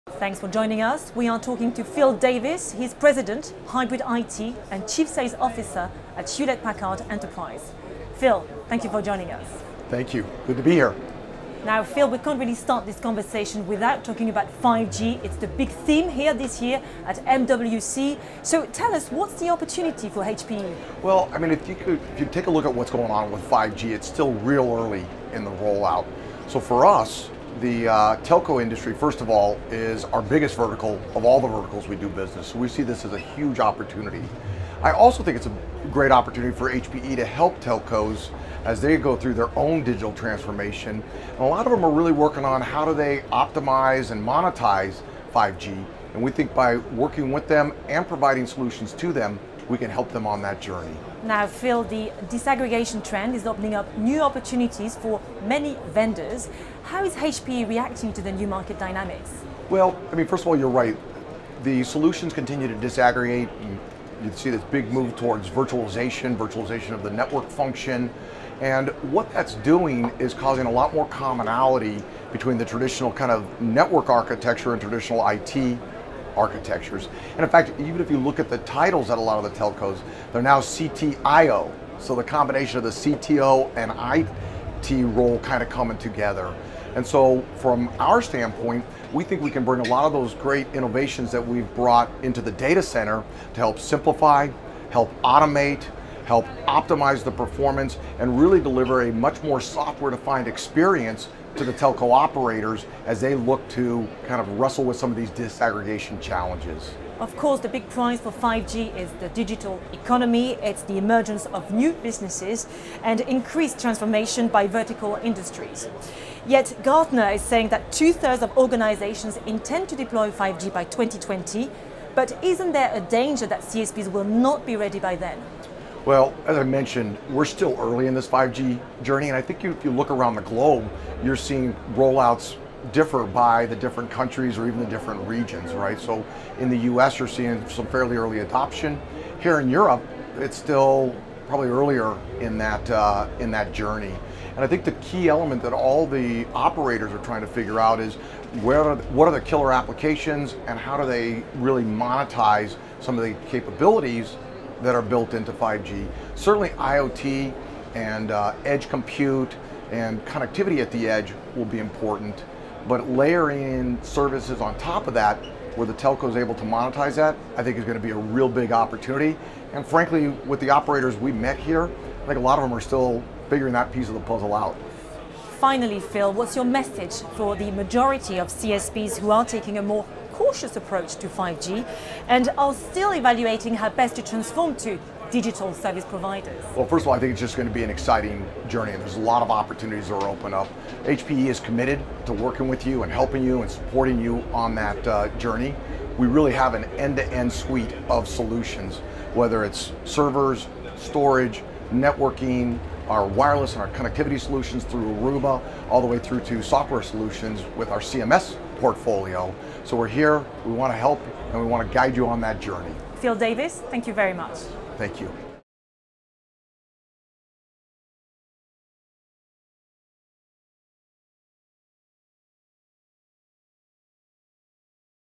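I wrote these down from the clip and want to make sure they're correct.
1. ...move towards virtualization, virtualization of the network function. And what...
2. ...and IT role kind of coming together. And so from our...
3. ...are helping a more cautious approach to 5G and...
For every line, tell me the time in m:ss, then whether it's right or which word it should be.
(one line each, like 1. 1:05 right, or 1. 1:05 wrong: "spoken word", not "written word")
1. 1:04 right
2. 1:23 right
3. 2:59 wrong: "taking", not "helping".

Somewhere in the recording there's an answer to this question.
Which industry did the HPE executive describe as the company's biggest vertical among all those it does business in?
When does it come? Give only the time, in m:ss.
0:28.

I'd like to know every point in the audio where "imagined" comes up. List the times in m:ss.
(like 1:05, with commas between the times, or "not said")
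not said.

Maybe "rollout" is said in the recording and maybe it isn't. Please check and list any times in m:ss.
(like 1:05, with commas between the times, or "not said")
0:25, 2:11.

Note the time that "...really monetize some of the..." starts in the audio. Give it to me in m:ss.
2:31.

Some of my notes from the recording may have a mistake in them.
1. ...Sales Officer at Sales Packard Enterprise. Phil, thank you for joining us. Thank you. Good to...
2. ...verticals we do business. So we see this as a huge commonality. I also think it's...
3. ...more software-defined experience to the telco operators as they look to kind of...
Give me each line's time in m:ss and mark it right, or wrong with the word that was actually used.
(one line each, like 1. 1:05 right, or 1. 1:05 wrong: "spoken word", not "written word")
1. 0:05 wrong: "Hewlett", not "Sales"
2. 0:31 wrong: "opportunity", not "commonality"
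3. 1:39 right.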